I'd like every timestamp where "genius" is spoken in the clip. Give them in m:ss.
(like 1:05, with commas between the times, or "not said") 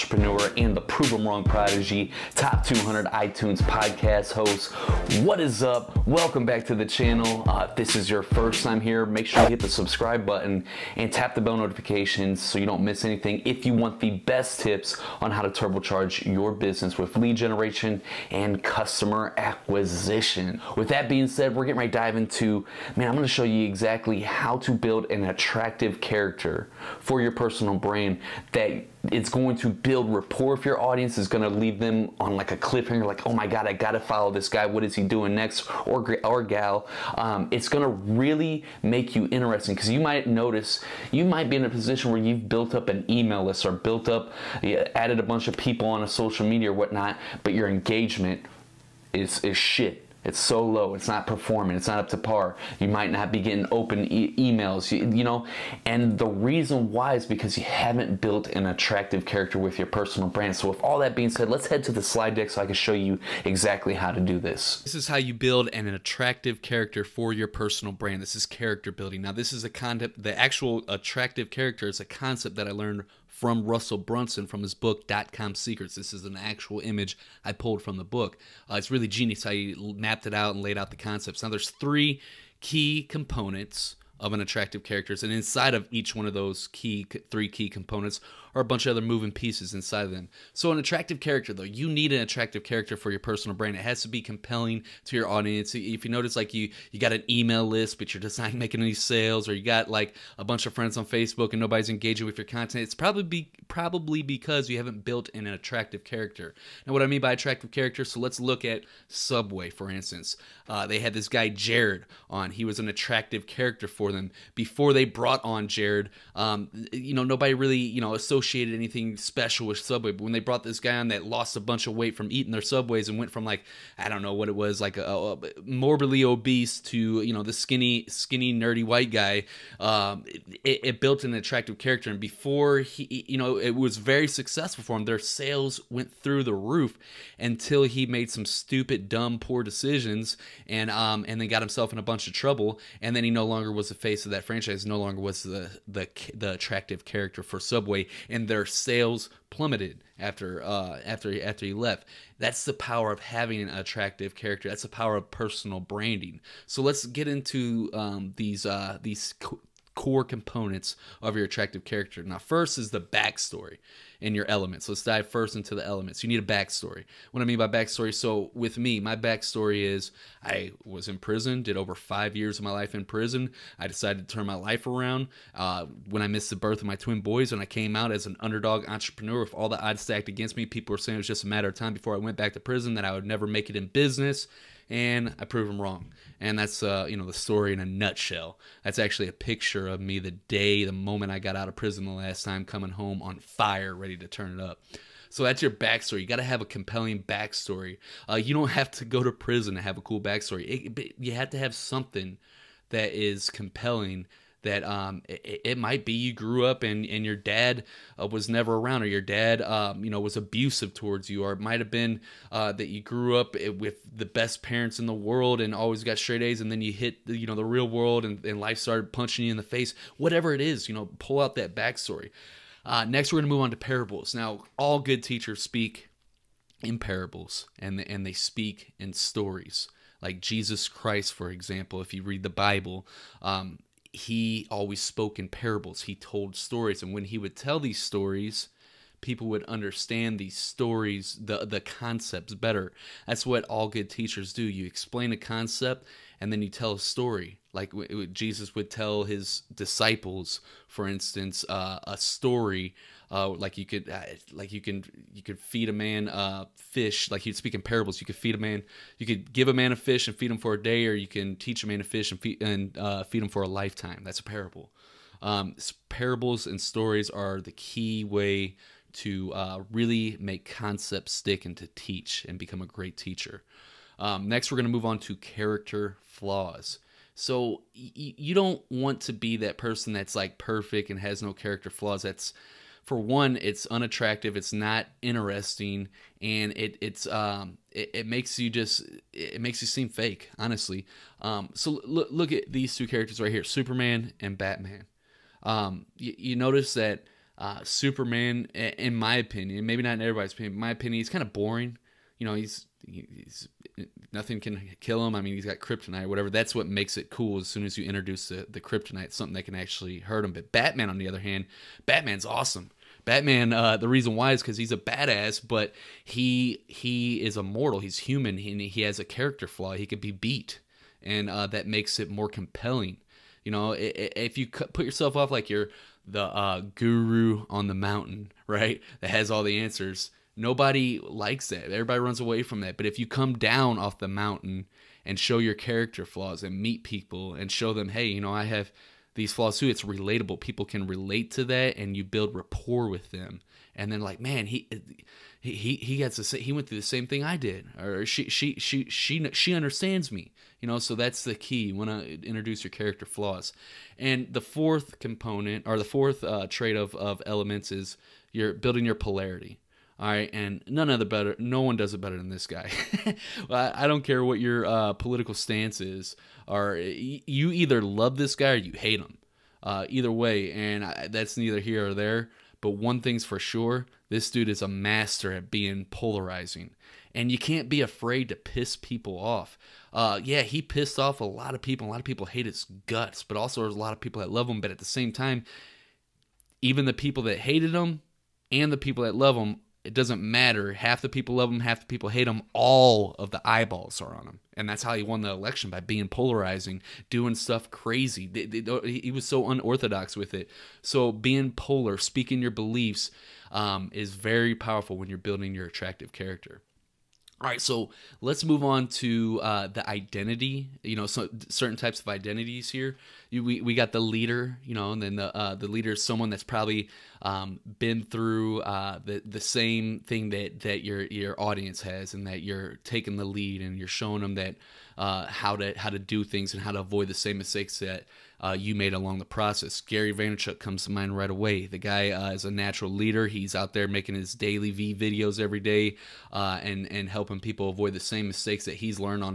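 1:19.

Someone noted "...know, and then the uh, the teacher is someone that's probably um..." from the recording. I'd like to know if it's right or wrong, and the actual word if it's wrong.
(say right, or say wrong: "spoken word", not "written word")
wrong: "leader", not "teacher".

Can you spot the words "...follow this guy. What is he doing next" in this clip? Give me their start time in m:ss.
0:33.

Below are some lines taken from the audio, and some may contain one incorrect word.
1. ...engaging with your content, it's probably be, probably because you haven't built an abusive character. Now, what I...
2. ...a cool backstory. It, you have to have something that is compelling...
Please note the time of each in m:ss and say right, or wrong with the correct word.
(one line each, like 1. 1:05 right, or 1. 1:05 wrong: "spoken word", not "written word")
1. 1:41 wrong: "attractive", not "abusive"
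2. 3:19 right.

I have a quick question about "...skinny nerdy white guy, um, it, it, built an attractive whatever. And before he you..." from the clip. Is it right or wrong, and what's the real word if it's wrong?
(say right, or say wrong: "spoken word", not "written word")
wrong: "character", not "whatever".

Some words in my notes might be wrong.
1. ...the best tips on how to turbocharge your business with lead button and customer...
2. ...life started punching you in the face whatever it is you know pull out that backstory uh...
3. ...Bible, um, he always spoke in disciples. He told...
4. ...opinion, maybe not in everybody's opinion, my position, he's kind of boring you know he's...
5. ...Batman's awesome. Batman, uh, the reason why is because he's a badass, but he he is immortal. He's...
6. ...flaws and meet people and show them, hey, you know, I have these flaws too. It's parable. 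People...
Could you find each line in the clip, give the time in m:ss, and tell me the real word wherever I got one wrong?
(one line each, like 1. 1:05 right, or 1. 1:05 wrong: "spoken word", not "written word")
1. 0:13 wrong: "generation", not "button"
2. 3:38 right
3. 3:52 wrong: "parables", not "disciples"
4. 4:59 wrong: "opinion", not "position"
5. 5:12 right
6. 5:36 wrong: "relatable", not "parable".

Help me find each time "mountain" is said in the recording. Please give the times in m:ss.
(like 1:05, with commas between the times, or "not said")
5:27, 5:34.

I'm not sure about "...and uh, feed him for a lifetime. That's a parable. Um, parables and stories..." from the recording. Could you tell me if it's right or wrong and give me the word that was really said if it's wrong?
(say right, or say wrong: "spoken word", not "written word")
right.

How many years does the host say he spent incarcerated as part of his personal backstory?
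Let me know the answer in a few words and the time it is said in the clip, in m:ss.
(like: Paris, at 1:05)
over 5 years, at 2:51.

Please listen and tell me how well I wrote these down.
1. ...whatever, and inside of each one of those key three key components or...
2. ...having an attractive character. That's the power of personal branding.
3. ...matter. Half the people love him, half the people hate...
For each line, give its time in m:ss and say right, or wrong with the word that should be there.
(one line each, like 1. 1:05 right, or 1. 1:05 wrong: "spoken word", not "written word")
1. 1:24 wrong: "character", not "whatever"
2. 2:33 right
3. 6:30 right.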